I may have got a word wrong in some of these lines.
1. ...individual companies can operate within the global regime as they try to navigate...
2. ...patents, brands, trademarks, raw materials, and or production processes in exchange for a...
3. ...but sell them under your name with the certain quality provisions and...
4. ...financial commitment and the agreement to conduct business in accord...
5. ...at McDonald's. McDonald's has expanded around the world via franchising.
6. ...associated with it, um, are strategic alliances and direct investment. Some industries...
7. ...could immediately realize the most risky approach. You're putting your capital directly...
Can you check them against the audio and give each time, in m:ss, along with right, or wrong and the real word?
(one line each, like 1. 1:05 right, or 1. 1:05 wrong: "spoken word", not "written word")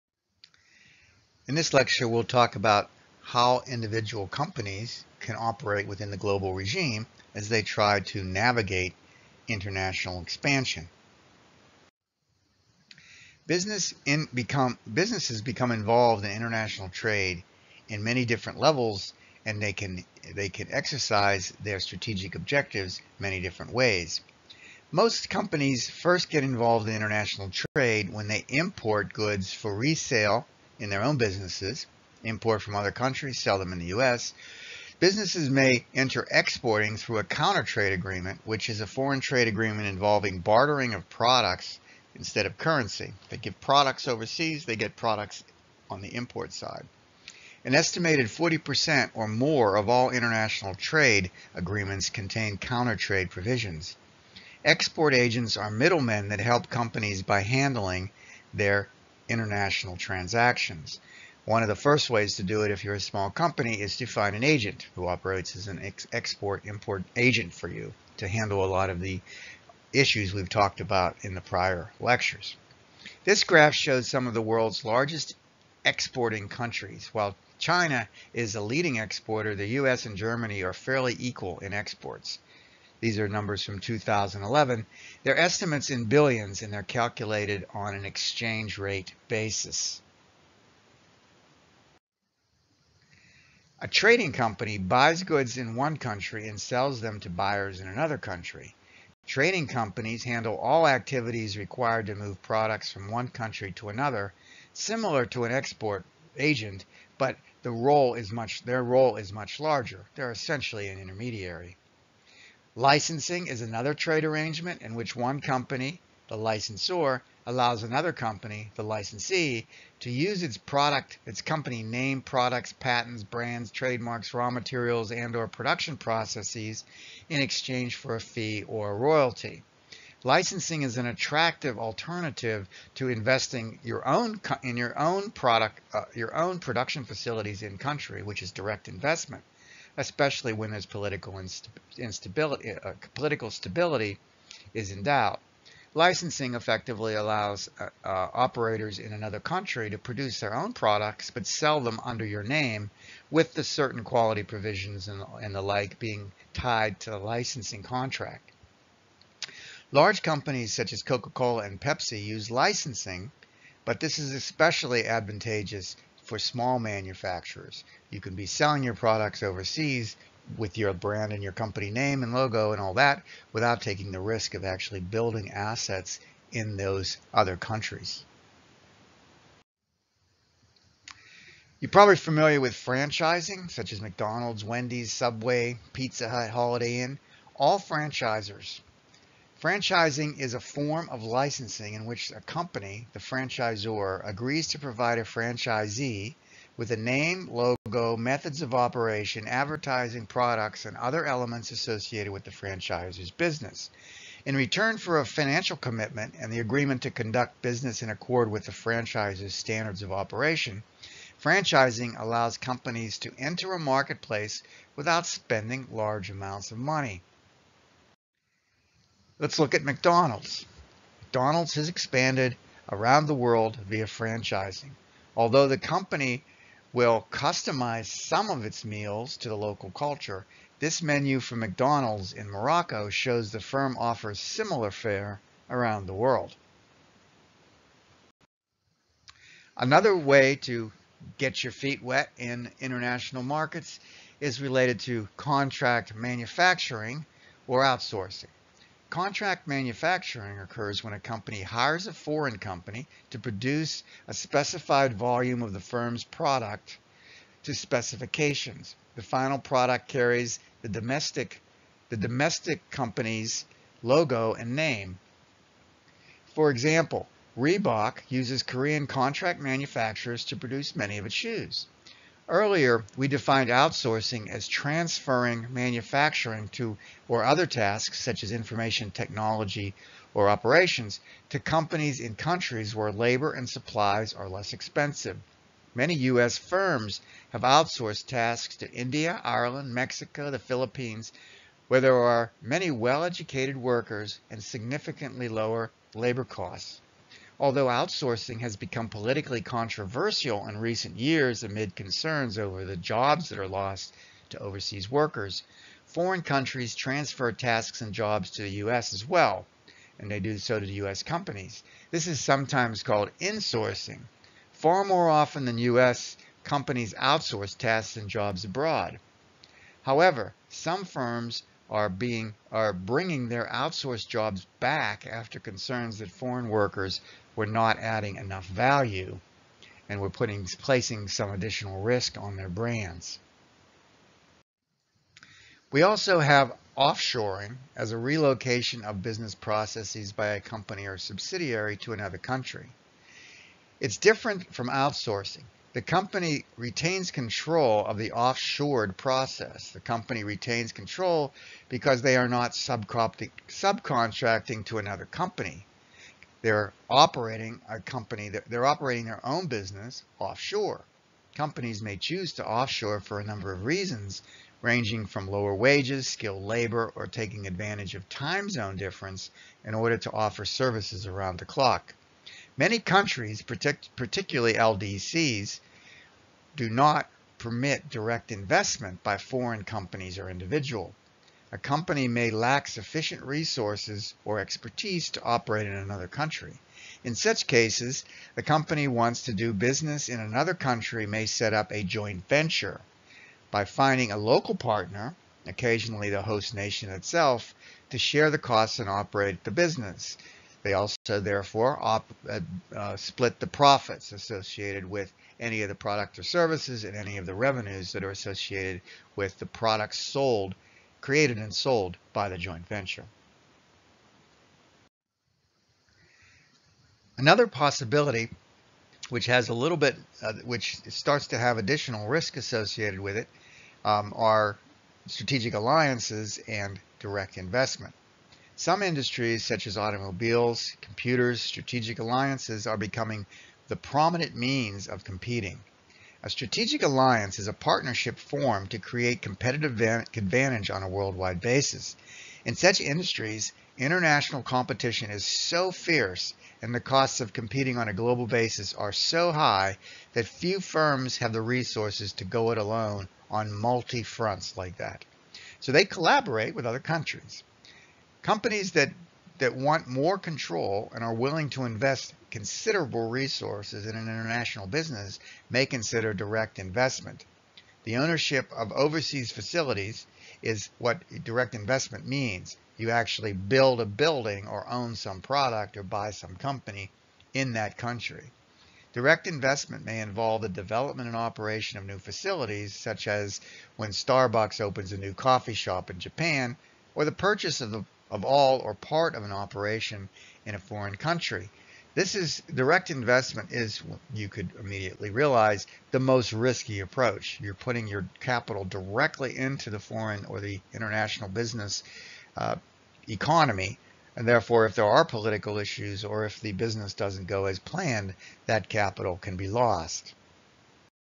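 1. 0:03 right
2. 2:02 right
3. 2:31 right
4. 3:25 right
5. 3:39 right
6. 7:02 right
7. 8:14 right.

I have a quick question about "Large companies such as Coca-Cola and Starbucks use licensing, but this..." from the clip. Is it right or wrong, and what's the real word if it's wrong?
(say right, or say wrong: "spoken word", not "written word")
wrong: "Pepsi", not "Starbucks".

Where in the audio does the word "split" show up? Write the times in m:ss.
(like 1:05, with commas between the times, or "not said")
6:43.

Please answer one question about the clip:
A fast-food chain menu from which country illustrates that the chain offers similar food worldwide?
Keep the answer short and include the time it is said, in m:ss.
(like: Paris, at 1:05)
Morocco, at 3:52.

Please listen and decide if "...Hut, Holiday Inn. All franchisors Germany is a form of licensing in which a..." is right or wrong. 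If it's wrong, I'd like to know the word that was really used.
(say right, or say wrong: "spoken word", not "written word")
wrong: "Franchising", not "Germany".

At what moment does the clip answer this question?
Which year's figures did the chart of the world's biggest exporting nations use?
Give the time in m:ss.
1:23.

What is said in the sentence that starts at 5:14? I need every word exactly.
Far more often than U.S., companies outsource tasks and jobs abroad.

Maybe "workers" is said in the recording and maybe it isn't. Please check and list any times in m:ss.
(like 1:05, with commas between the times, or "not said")
4:53, 5:05, 5:26.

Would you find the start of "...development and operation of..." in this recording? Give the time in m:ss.
8:00.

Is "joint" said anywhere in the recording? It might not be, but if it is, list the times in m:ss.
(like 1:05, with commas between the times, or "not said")
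6:32, 6:52.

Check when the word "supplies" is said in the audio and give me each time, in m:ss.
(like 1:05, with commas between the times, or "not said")
4:43.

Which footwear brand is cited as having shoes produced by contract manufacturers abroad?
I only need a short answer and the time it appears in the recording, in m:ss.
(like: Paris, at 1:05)
Reebok, at 4:27.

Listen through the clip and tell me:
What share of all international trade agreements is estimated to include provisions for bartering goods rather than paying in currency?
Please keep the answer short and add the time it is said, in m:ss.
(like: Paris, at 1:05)
40%, at 0:48.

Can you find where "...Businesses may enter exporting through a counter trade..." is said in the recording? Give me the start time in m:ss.
0:34.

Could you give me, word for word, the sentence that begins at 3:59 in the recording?
Another way to get your feet wet in international markets is related to contract manufacturing or outsourcing.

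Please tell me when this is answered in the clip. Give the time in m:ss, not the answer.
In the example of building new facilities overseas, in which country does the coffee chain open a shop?
8:06.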